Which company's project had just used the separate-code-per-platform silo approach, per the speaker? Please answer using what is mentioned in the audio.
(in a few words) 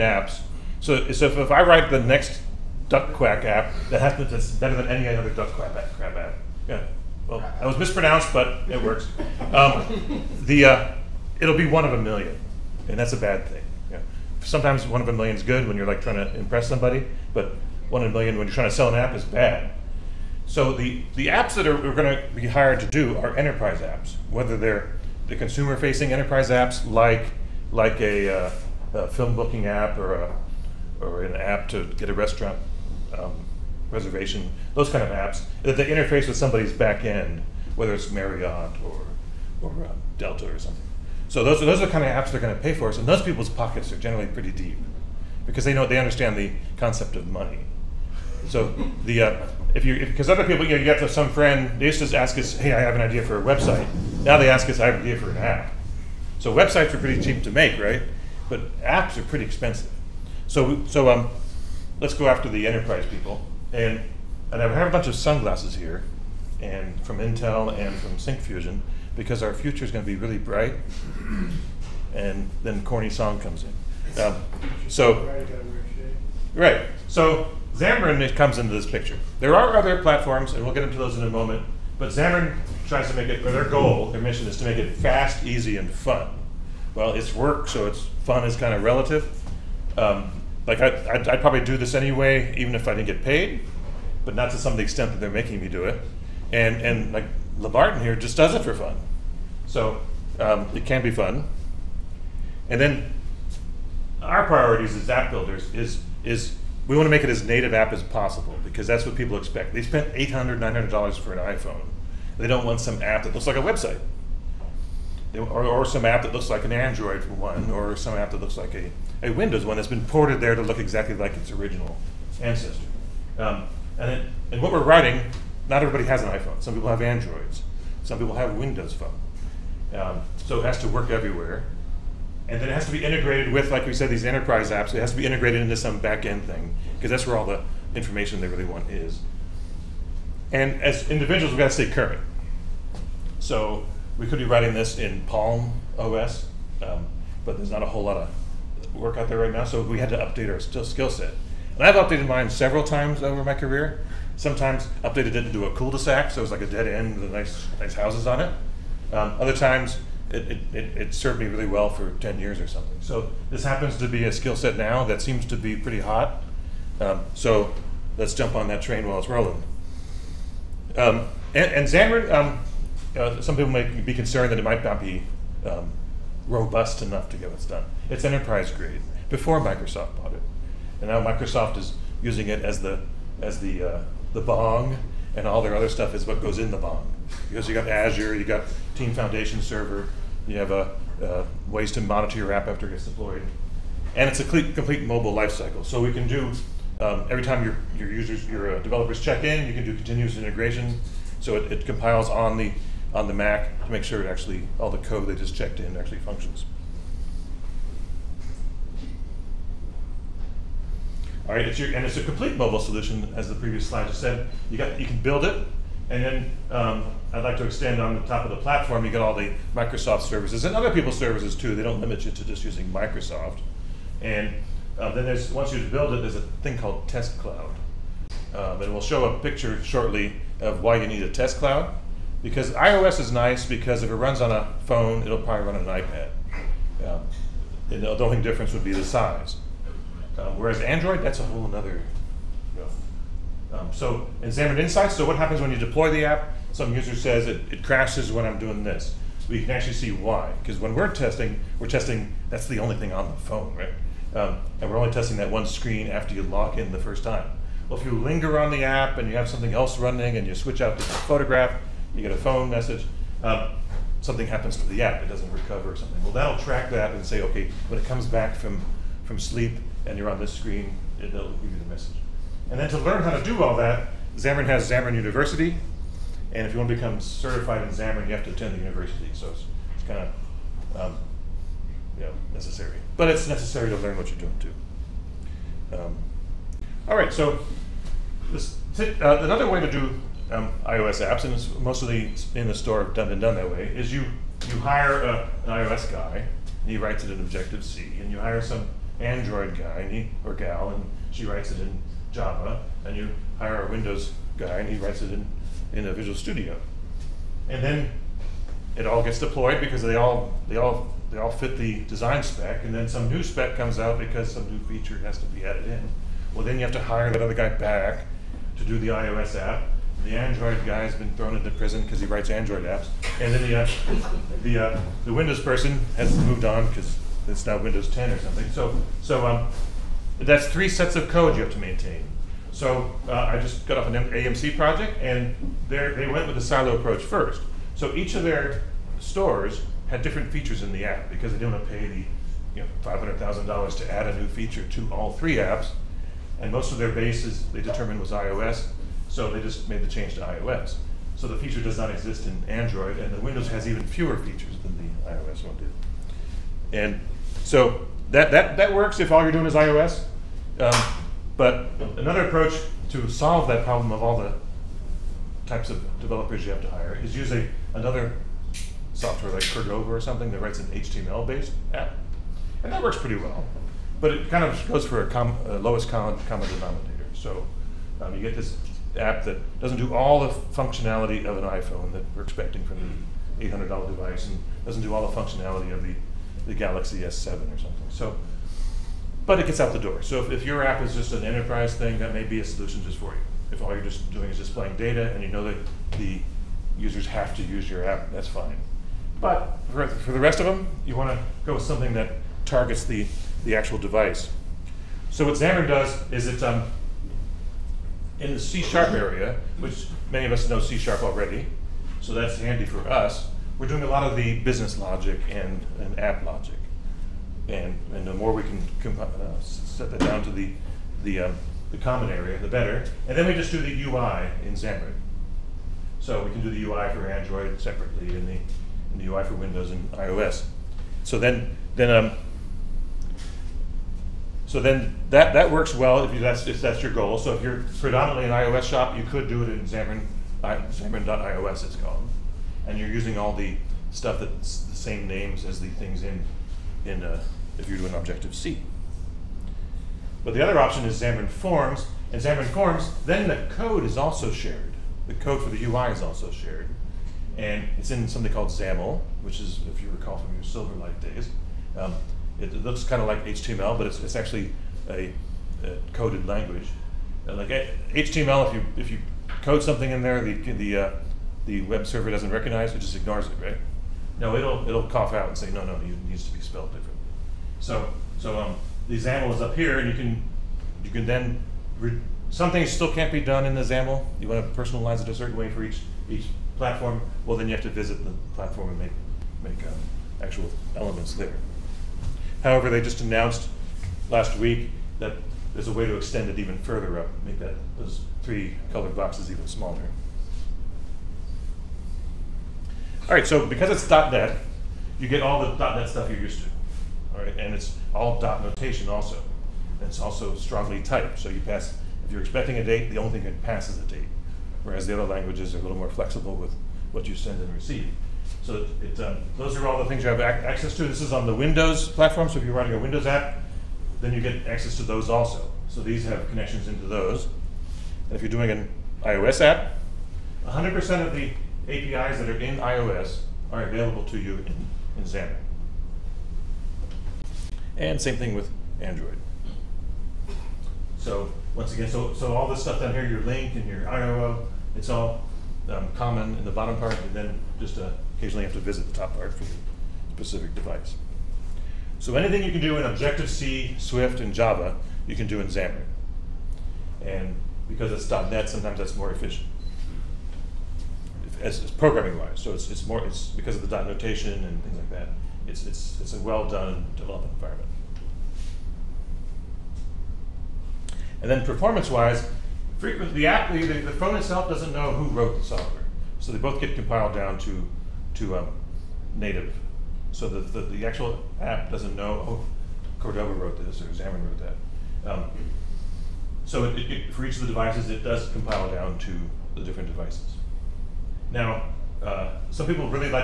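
AMC.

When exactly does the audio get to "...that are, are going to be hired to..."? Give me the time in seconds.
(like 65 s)
21 s.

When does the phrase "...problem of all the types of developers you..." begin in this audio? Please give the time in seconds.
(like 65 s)
363 s.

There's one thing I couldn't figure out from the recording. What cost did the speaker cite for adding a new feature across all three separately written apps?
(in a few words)
$500,000.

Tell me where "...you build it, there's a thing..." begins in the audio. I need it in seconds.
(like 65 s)
225 s.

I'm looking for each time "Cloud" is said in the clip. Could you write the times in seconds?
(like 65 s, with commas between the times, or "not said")
227 s, 231 s.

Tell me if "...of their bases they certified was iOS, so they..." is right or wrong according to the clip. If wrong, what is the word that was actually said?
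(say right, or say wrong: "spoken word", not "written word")
wrong: "determined", not "certified".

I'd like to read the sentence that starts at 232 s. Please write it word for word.
Because iOS is nice because if it runs on a phone, it'll probably run on an iPad.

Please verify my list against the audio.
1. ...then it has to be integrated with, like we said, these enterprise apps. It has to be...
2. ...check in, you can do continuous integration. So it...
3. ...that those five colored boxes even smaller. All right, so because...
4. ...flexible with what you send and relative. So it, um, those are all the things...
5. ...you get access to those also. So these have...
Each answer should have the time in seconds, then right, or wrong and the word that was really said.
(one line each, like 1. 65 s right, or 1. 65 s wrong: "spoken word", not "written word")
1. 132 s right
2. 199 s right
3. 497 s wrong: "three", not "five"
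4. 516 s wrong: "receive", not "relative"
5. 524 s right.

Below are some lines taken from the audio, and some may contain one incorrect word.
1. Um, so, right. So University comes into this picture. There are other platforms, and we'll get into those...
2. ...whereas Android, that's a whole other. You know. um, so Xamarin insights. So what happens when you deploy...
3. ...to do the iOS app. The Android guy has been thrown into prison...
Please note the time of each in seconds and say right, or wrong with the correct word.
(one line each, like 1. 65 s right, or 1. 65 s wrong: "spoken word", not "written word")
1. 74 s wrong: "Xamarin", not "University"
2. 240 s right
3. 318 s right.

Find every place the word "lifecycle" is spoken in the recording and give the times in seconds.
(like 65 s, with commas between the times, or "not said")
195 s.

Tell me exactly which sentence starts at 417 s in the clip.
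And, and the more we can comp- uh, set that down to the, the, um, the common area, the better.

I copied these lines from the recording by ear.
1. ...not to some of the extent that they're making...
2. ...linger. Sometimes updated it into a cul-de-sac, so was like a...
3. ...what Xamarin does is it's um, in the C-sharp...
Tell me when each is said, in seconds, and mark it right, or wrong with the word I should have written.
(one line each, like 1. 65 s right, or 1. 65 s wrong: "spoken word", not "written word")
1. 94 s right
2. 153 s wrong: "career", not "linger"
3. 405 s right.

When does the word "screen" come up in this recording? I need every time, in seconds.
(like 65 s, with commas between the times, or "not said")
255 s, 270 s.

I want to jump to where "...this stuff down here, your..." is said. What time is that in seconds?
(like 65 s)
542 s.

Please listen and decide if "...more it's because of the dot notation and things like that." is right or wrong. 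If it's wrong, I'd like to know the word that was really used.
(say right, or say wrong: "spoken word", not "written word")
right.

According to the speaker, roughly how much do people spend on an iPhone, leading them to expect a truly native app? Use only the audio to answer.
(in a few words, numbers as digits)
$800-$900.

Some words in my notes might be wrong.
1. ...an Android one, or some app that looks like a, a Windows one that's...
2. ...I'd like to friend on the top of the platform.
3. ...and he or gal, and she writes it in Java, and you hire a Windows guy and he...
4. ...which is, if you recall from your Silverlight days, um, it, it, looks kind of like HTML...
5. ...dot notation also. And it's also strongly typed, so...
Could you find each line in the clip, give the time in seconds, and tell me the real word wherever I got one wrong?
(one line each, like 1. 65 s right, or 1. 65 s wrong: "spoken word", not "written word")
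1. 116 s right
2. 217 s wrong: "extend", not "friend"
3. 300 s right
4. 459 s right
5. 508 s right.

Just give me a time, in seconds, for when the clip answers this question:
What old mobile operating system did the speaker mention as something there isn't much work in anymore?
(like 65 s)
145 s.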